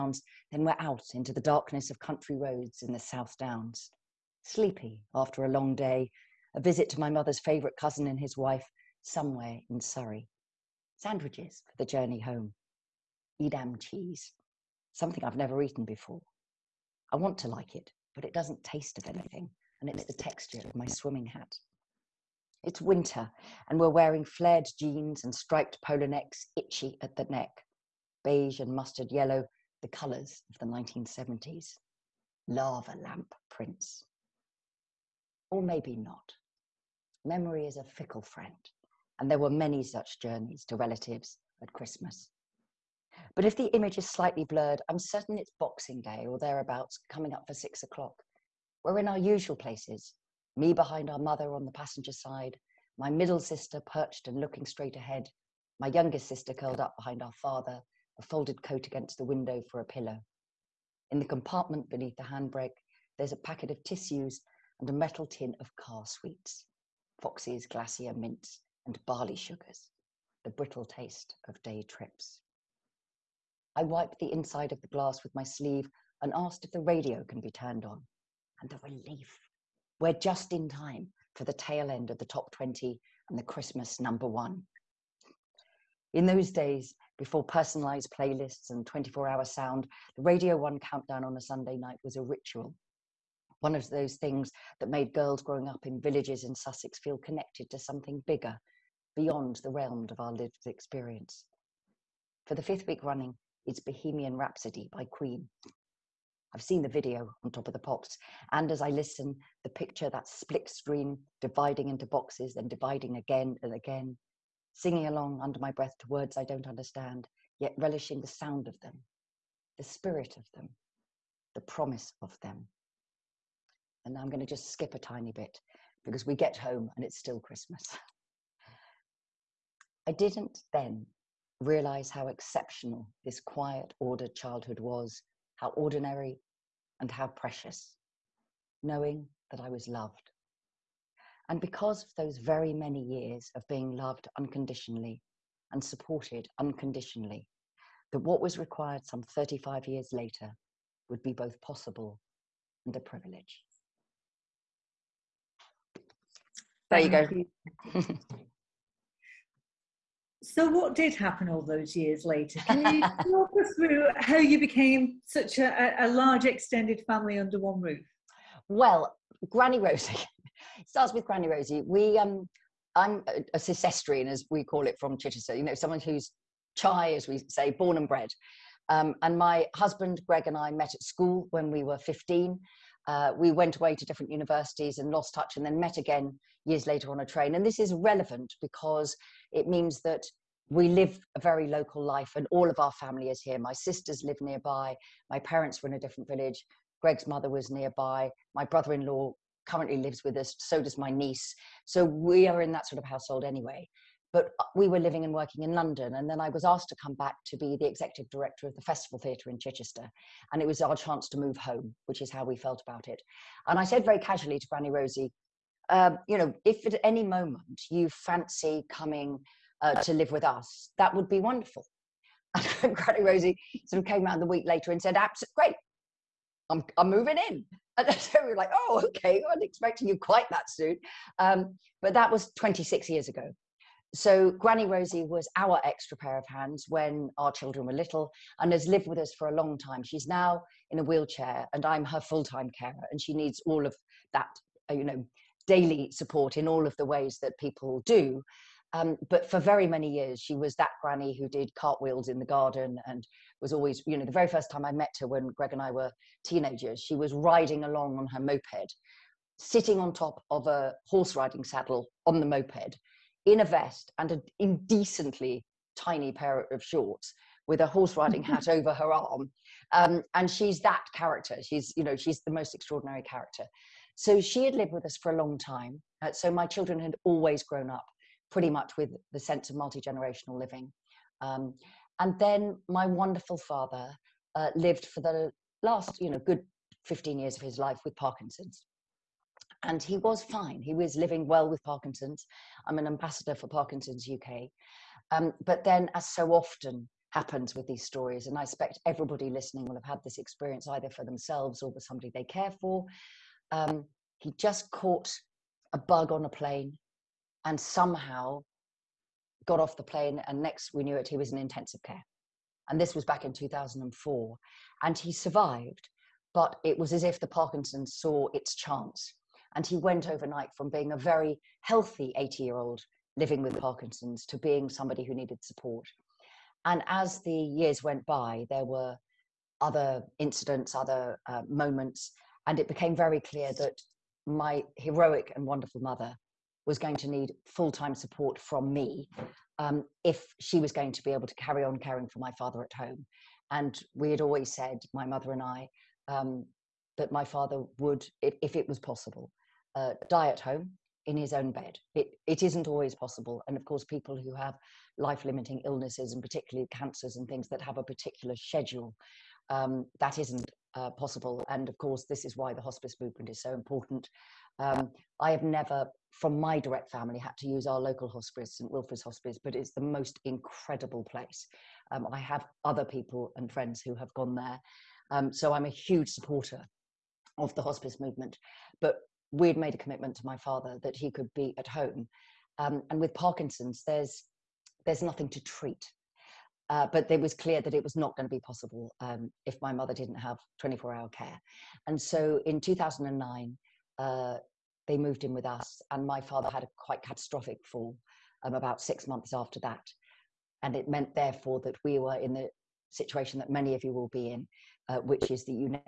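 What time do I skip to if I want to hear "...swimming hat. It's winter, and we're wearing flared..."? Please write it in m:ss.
0:20.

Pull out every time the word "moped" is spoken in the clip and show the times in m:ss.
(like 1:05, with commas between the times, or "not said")
4:18, 4:22.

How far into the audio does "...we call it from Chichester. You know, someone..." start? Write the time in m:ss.
2:54.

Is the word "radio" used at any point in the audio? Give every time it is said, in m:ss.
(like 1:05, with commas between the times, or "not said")
1:16, 1:30.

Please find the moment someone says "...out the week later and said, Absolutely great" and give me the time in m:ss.
3:44.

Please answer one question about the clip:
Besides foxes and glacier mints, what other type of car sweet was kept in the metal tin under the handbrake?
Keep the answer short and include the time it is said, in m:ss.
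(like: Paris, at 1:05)
barley sugars, at 1:09.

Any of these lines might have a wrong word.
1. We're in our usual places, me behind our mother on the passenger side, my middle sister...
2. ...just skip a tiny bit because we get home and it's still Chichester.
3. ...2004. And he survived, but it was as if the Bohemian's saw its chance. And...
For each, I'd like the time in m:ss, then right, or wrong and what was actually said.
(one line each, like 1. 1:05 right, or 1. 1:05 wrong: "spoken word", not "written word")
1. 0:48 right
2. 2:04 wrong: "Christmas", not "Chichester"
3. 5:13 wrong: "Parkinson", not "Bohemian".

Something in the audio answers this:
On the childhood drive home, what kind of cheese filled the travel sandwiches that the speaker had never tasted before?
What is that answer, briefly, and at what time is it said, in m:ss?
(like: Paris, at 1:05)
Edam, at 0:13.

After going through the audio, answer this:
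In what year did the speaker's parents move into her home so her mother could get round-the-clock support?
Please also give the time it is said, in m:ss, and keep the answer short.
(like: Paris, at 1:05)
2009, at 6:32.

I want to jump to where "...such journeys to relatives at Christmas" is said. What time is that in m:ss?
0:39.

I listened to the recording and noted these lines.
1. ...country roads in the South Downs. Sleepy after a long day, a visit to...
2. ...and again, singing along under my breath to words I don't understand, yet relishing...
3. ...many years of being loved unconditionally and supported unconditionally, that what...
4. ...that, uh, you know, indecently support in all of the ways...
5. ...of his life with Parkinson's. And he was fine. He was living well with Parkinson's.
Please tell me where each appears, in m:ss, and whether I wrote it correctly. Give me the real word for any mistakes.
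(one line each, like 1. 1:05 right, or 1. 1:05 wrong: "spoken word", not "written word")
1. 0:01 right
2. 1:53 right
3. 2:22 right
4. 4:04 wrong: "daily", not "indecently"
5. 4:47 right.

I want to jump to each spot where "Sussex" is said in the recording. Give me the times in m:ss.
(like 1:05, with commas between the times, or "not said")
1:36.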